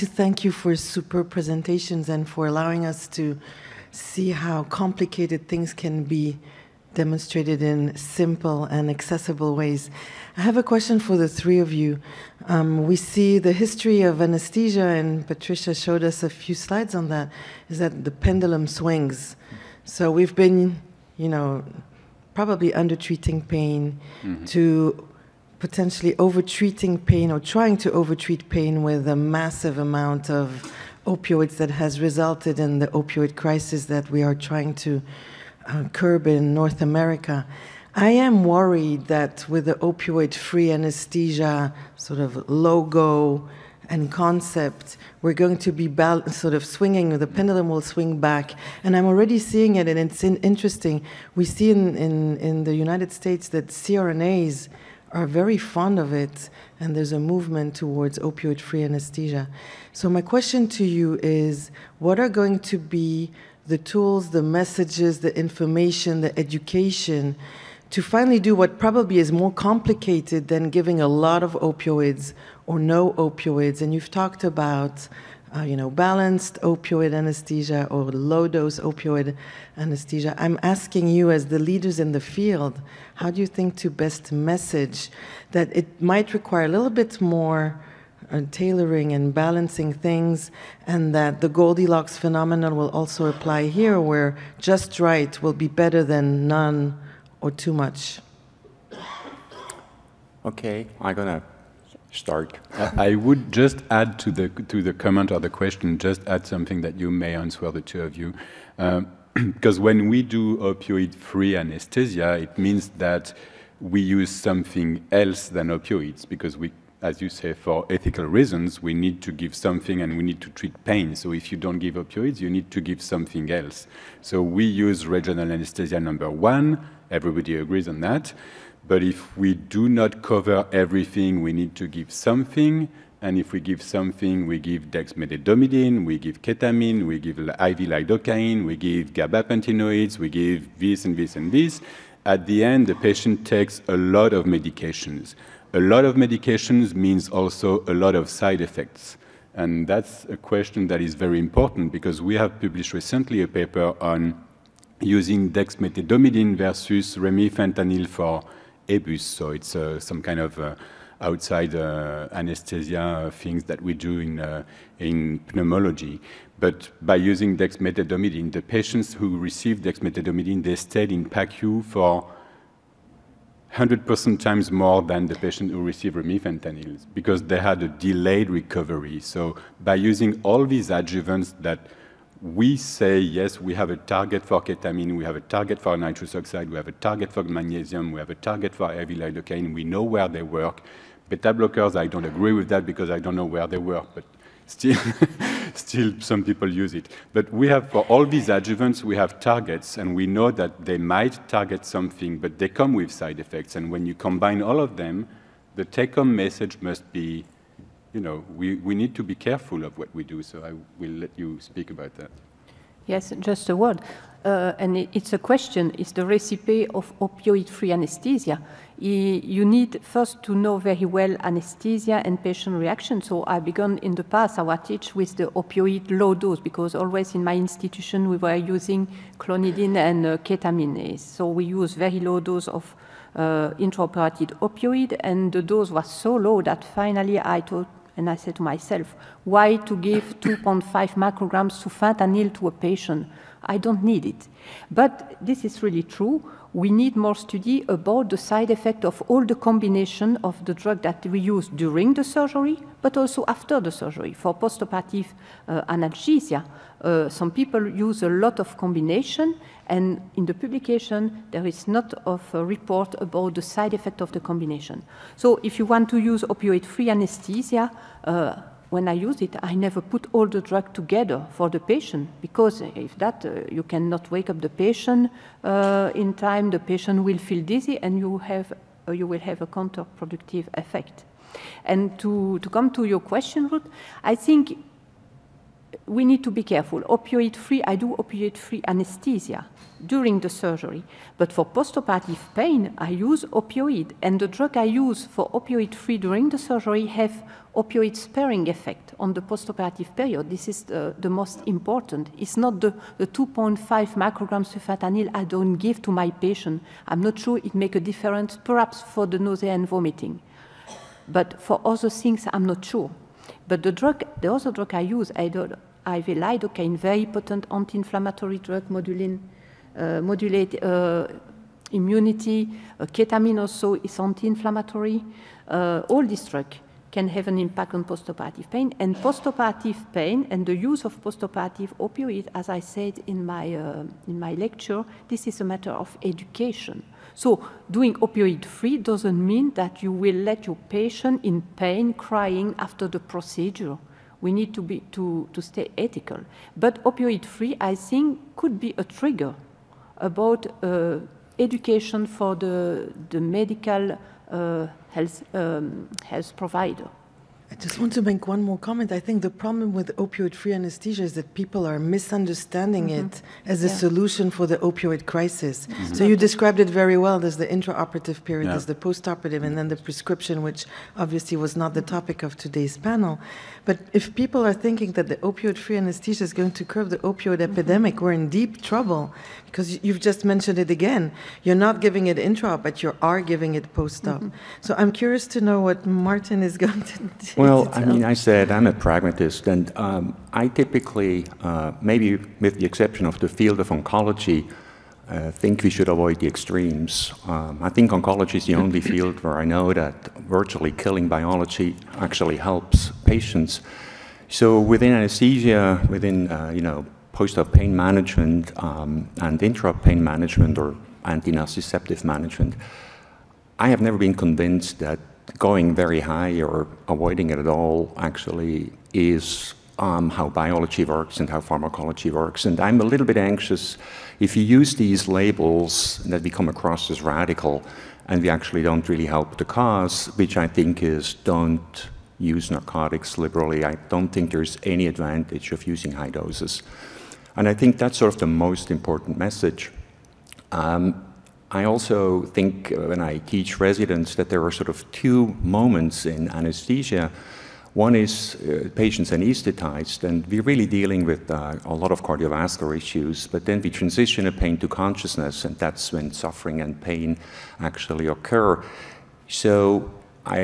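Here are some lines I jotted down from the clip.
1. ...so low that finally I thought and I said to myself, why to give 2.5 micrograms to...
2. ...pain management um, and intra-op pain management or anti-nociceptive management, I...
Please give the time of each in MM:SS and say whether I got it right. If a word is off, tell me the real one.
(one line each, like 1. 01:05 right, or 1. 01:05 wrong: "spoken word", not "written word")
1. 03:56 right
2. 06:47 right.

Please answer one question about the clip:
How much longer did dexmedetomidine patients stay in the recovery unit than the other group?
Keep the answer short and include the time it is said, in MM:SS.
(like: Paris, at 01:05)
100%, at 02:53.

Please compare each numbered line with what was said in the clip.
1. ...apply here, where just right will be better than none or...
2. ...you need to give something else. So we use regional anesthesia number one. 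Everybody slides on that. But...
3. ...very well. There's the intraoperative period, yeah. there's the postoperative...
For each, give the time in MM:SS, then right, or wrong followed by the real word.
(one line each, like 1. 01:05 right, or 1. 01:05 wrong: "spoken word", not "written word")
1. 01:33 right
2. 02:02 wrong: "agrees", not "slides"
3. 06:07 right.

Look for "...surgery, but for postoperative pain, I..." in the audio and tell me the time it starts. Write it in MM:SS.
04:50.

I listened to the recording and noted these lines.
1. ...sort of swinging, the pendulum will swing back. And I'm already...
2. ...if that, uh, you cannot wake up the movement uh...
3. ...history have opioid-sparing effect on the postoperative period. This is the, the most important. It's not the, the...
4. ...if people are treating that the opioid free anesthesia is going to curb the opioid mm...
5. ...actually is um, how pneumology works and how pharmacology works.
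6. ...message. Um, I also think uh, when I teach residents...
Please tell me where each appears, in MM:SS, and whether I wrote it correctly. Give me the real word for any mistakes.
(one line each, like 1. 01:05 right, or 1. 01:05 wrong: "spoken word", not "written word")
1. 00:46 right
2. 04:32 wrong: "patient", not "movement"
3. 04:56 wrong: "surgery", not "history"
4. 06:14 wrong: "thinking", not "treating"
5. 06:58 wrong: "biology", not "pneumology"
6. 07:19 right.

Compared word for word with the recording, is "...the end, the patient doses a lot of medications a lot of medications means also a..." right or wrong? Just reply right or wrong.
wrong.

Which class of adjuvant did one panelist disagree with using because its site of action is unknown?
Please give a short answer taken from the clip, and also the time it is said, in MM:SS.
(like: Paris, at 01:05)
Beta blockers, at 03:11.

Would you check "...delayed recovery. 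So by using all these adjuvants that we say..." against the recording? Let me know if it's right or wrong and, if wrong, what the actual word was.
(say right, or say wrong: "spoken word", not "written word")
right.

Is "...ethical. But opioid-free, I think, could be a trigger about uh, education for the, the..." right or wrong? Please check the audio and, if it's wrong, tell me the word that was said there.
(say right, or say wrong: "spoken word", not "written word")
right.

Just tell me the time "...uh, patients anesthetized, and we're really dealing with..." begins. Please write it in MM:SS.
07:28.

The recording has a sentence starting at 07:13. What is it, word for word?
I don't think there's any advantage of using high doses.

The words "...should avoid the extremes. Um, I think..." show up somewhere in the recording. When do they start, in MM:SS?
06:35.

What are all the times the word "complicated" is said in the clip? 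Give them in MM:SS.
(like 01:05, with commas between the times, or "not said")
00:04, 01:09.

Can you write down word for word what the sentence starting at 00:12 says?
Um, we see the history of anesthesia, and Patricia showed us a few slides on that, is that the pendulum swings.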